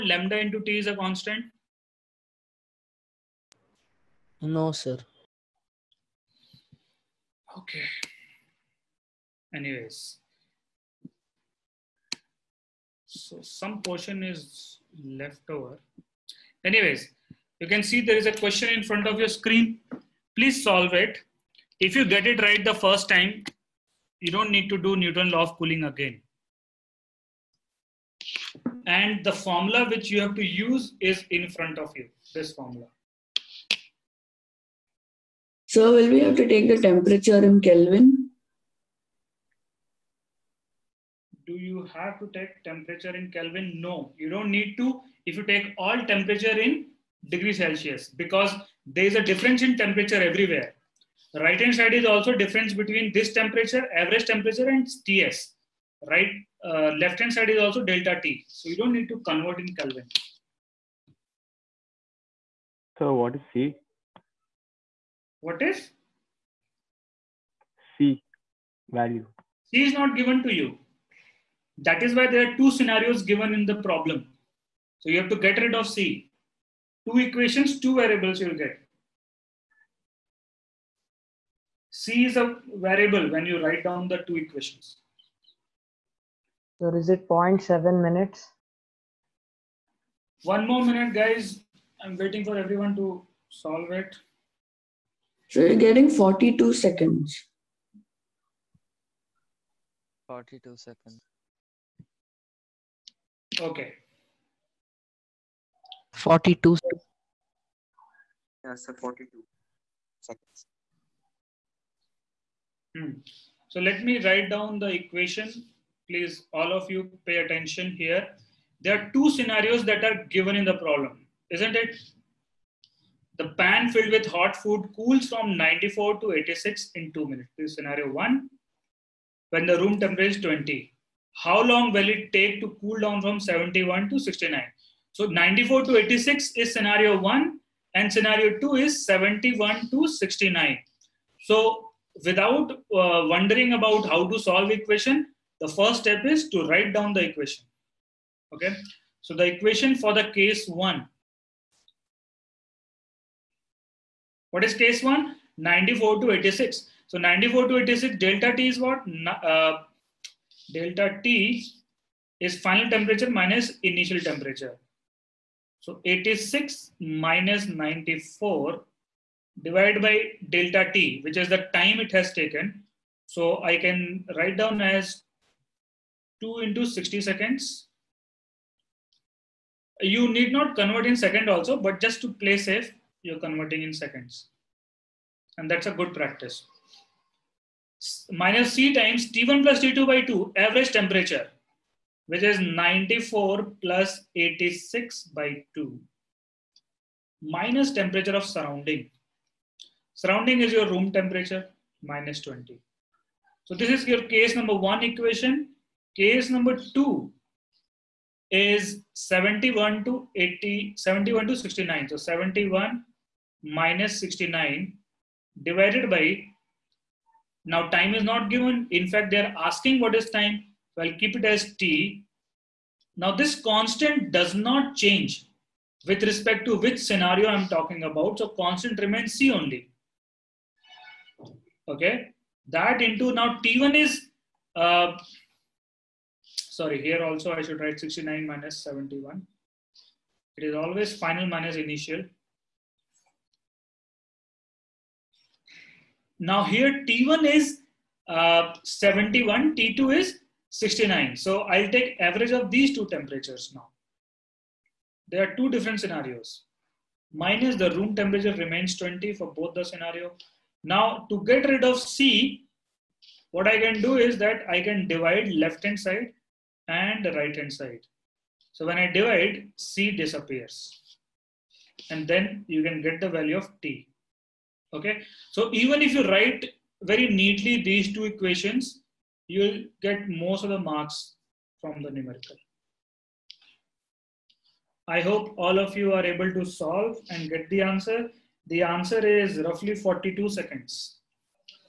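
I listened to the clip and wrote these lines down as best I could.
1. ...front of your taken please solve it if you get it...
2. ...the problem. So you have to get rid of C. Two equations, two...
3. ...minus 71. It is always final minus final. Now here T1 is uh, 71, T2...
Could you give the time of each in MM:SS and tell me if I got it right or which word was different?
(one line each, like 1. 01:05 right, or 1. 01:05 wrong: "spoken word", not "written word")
1. 00:18 wrong: "screen", not "taken"
2. 01:13 right
3. 03:58 wrong: "initial", not "final".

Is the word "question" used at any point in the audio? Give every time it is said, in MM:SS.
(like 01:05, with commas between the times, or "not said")
00:18.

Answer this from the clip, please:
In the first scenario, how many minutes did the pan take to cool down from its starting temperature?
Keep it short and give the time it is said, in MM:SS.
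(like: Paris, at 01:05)
2 minutes, at 02:06.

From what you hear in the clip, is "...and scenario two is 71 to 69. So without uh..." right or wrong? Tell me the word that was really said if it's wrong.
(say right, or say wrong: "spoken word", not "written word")
right.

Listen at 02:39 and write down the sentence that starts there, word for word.
Uh, delta T is final temperature minus initial temperature.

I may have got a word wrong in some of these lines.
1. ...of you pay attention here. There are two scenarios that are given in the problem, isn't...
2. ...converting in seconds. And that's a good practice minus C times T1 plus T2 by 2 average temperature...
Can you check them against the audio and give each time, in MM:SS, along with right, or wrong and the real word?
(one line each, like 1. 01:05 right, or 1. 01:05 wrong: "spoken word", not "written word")
1. 01:56 right
2. 03:03 right.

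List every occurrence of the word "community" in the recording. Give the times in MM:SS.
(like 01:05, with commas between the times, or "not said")
not said.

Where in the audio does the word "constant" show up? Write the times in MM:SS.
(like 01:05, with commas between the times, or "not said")
00:00, 03:43, 03:48.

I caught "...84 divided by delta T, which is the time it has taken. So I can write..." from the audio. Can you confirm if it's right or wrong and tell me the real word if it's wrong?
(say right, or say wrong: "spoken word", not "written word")
wrong: "94", not "84".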